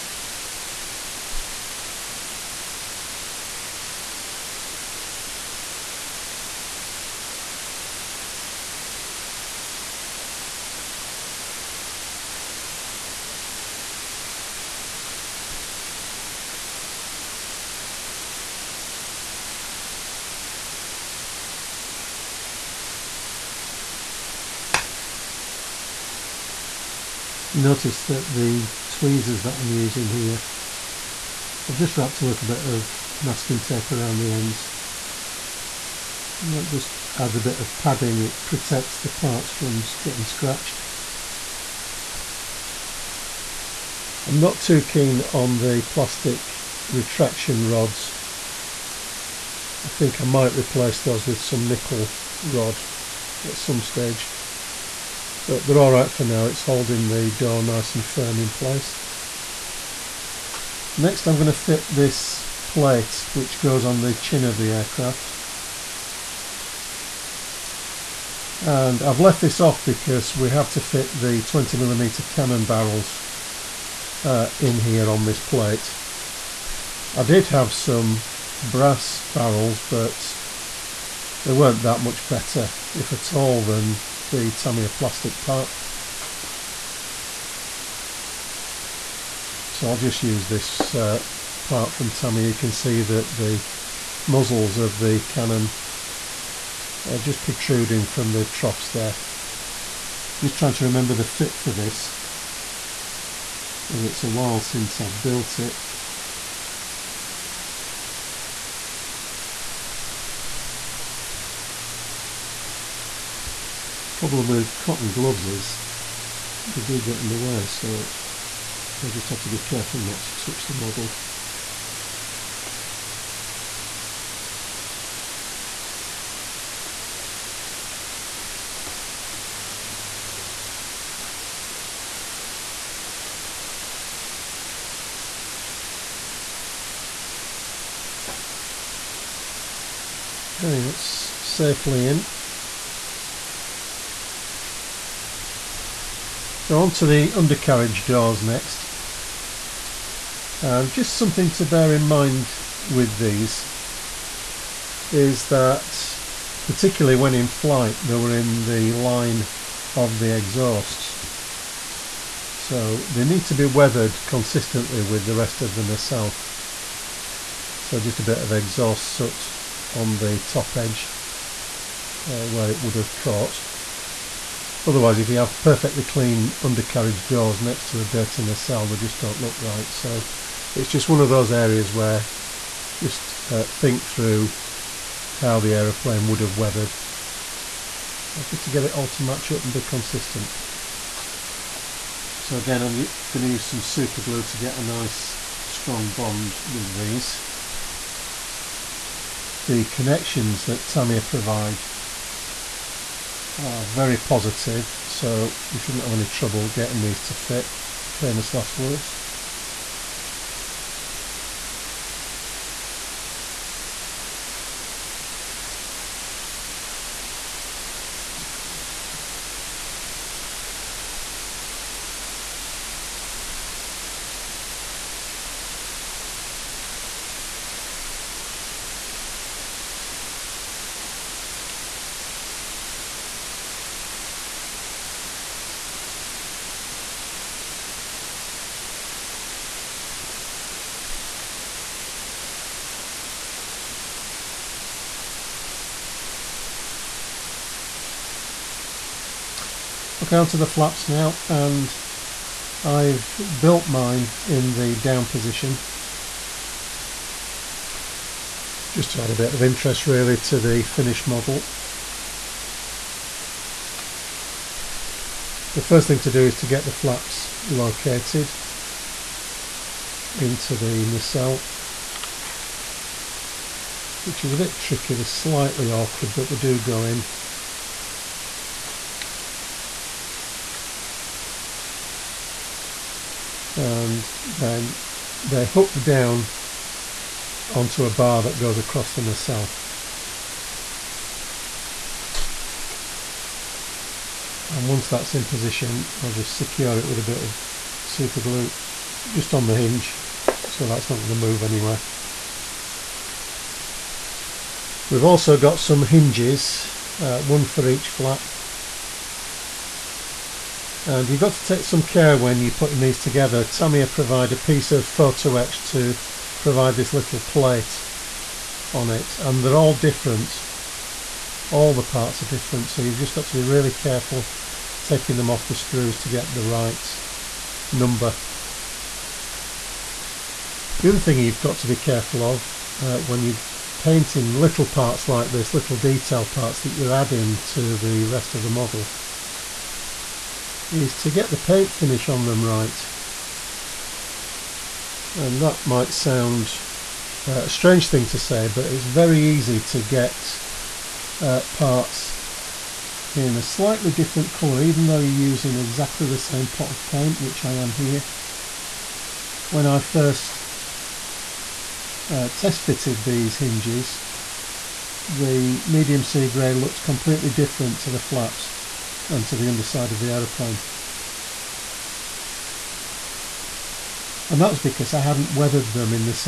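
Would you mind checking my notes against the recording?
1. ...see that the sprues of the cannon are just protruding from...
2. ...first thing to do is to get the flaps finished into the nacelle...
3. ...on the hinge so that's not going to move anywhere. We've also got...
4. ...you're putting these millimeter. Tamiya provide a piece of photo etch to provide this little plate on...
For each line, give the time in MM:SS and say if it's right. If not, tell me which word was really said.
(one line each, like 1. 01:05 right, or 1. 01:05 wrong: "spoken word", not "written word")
1. 01:32 wrong: "muzzles", not "sprues"
2. 04:25 wrong: "located", not "finished"
3. 04:59 right
4. 05:12 wrong: "together", not "millimeter".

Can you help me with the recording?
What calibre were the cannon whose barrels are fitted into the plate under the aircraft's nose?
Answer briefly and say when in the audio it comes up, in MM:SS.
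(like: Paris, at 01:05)
20 millimeter, at 01:11.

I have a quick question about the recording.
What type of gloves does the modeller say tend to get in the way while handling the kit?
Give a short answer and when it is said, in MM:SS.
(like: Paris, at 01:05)
cotton gloves, at 01:54.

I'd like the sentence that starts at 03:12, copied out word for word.
So again, I'm going to use some super glue to get a nice strong bond with these.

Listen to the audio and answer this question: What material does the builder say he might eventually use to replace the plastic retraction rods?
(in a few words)
nickel rod.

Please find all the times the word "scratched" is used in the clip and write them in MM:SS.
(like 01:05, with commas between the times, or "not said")
00:40.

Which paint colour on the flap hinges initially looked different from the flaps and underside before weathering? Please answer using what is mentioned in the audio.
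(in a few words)
medium sea grey.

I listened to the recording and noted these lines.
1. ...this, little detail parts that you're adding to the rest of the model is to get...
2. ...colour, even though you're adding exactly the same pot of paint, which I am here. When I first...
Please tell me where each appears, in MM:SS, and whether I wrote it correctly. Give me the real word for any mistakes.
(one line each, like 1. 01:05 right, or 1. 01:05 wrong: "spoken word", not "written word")
1. 05:35 right
2. 05:54 wrong: "using", not "adding".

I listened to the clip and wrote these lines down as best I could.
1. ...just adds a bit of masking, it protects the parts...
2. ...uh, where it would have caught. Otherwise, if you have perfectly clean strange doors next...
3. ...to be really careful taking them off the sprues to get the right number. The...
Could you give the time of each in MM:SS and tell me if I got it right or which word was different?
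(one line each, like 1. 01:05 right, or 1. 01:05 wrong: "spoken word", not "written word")
1. 00:36 wrong: "padding", not "masking"
2. 02:52 wrong: "undercarriage", not "strange"
3. 05:23 right.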